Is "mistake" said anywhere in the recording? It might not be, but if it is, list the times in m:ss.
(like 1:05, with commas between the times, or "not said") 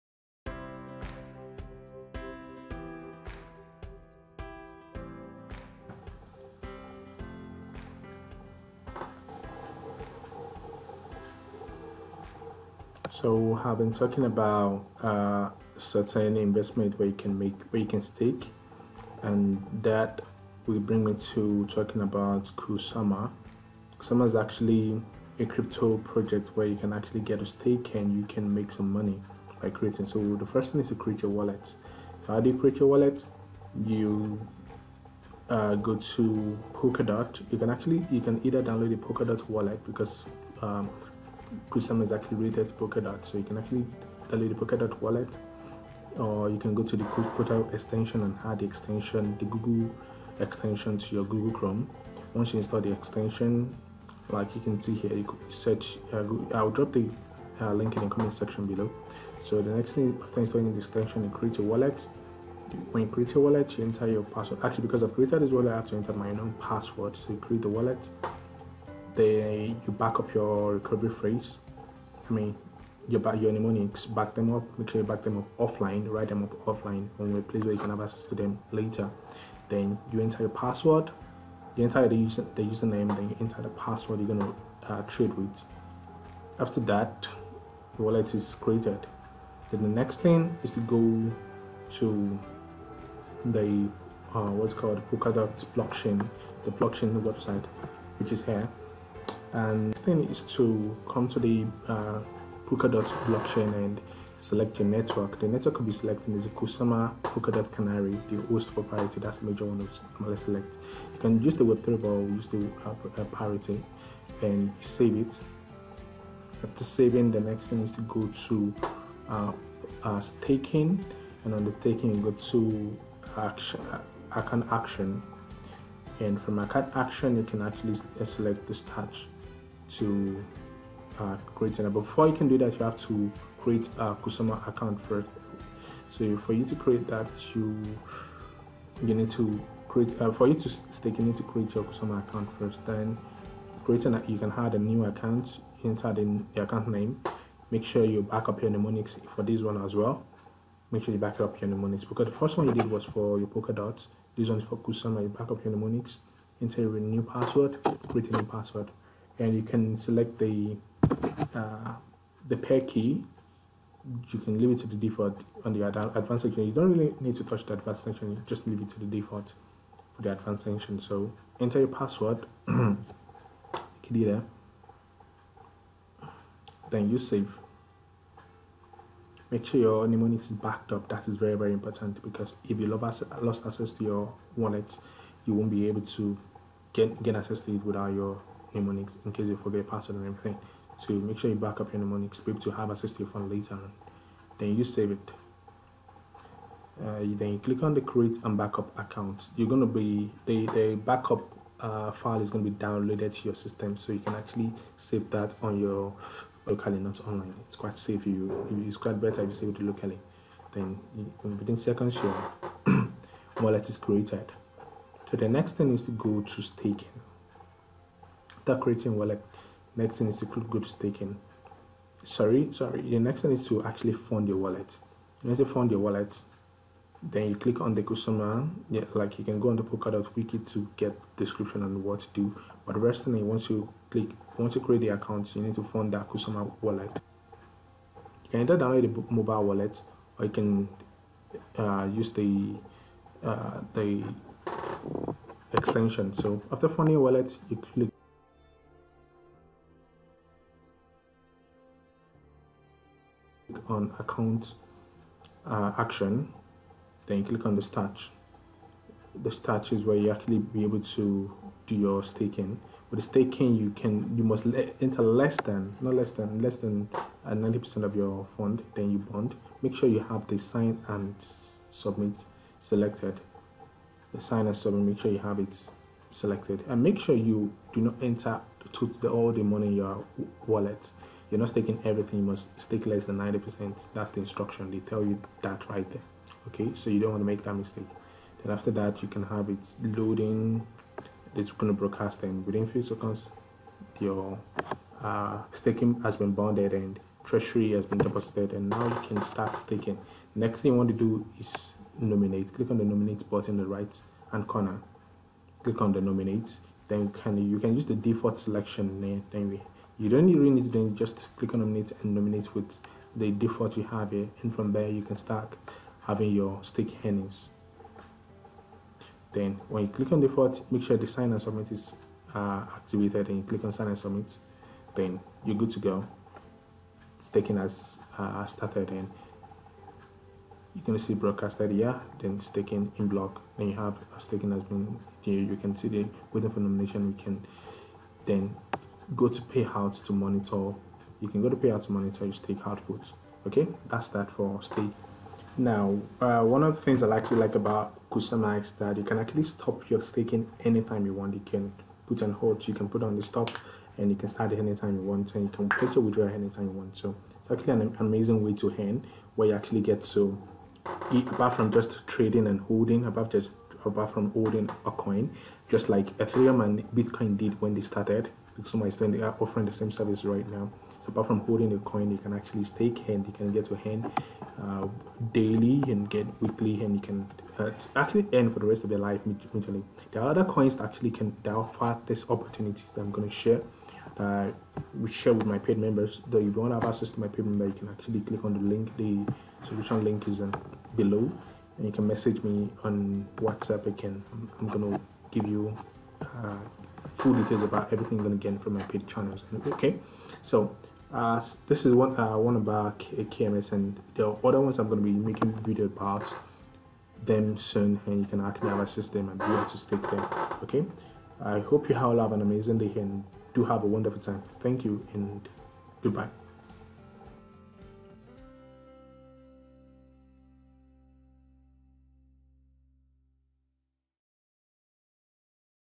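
4:47.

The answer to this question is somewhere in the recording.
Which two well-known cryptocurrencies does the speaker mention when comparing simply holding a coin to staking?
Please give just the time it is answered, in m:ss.
6:06.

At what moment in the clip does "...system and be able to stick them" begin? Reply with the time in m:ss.
6:49.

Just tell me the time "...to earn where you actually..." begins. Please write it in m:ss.
5:58.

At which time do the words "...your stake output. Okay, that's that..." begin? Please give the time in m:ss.
5:42.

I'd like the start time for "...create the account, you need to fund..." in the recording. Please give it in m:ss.
3:54.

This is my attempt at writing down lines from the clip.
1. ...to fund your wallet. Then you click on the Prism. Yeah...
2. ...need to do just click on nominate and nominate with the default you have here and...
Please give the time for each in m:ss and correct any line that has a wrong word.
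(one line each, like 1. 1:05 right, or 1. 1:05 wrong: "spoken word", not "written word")
1. 3:45 wrong: "Kusama", not "Prism"
2. 5:10 right.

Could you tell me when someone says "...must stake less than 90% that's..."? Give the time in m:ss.
4:42.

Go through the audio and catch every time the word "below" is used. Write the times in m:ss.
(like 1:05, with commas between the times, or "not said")
0:58, 6:31.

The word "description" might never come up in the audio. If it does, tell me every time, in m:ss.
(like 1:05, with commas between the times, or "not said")
3:51.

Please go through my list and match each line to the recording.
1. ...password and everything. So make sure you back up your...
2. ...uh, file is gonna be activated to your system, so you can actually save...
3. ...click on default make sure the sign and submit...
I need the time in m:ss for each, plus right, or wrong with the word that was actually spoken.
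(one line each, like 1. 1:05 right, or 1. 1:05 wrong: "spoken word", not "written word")
1. 3:09 right
2. 3:21 wrong: "downloaded", not "activated"
3. 5:20 right.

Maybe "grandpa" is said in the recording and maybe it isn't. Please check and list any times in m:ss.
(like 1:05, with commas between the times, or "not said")
not said.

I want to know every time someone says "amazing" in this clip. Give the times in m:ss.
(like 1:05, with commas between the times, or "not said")
5:58, 6:52.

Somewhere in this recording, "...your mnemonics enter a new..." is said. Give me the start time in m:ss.
2:35.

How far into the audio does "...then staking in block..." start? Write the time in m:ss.
5:32.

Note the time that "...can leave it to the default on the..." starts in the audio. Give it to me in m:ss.
2:44.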